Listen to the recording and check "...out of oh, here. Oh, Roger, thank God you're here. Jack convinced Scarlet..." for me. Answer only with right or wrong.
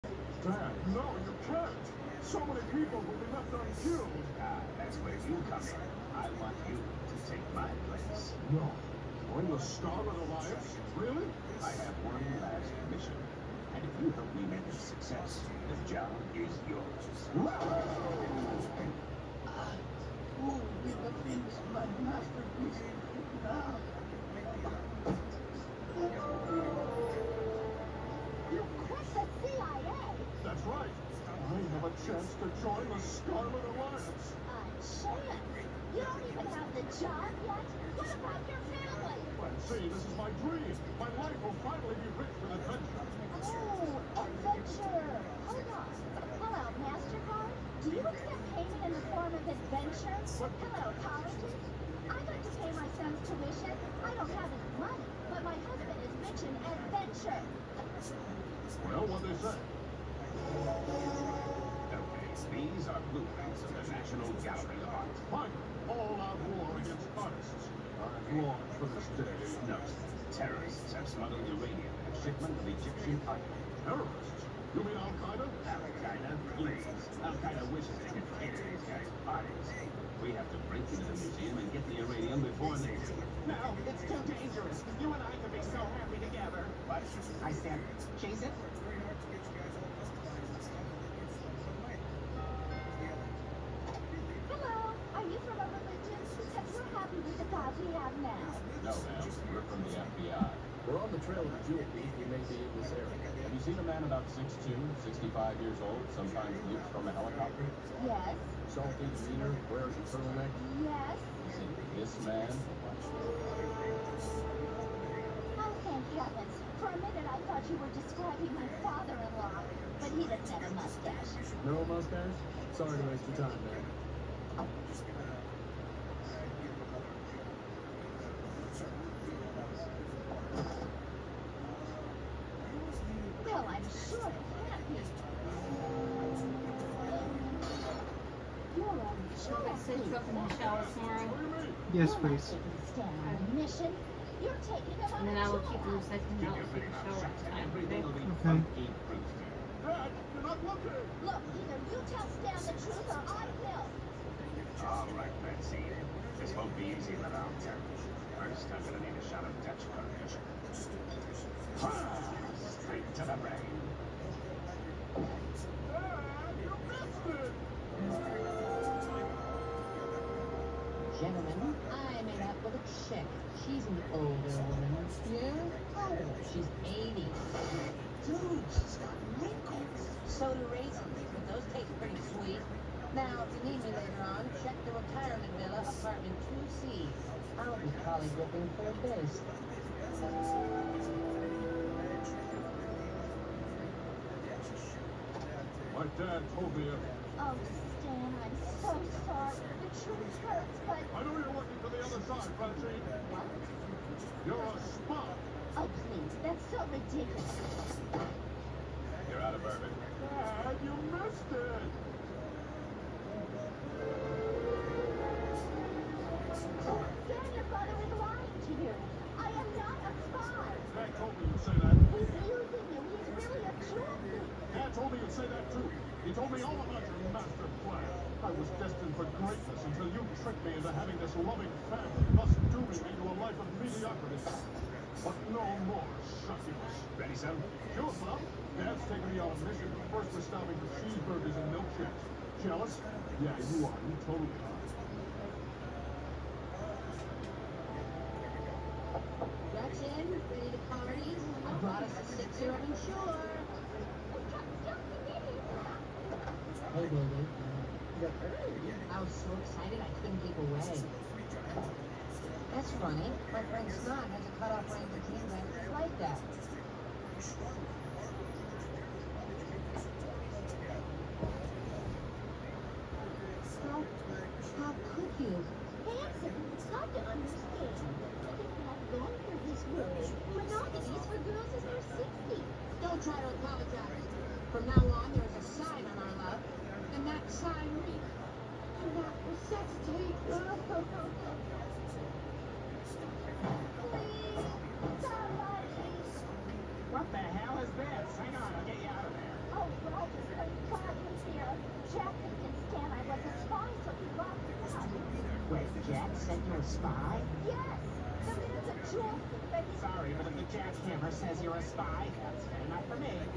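wrong.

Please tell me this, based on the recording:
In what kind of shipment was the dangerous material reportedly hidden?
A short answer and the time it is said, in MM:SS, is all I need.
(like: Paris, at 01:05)
Egyptian cotton, at 01:12.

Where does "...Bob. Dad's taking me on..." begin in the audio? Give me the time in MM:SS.
03:58.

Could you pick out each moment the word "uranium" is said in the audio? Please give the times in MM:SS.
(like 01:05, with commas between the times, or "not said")
01:11, 01:21.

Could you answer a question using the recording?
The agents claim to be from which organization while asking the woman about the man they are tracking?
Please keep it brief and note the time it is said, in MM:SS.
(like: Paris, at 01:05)
FBI, at 01:39.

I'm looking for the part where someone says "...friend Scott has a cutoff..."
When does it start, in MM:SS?
04:23.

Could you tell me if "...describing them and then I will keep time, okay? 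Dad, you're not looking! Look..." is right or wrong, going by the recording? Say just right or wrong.
wrong.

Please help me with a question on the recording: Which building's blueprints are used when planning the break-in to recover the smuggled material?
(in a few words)
National Gallery of Art.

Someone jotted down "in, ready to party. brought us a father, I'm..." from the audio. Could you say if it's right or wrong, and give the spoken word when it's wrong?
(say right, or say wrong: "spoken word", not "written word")
wrong: "sixer", not "father".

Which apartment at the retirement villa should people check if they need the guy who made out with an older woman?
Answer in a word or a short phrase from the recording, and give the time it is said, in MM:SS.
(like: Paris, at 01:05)
2C, at 03:06.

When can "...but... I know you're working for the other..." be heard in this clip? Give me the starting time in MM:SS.
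03:20.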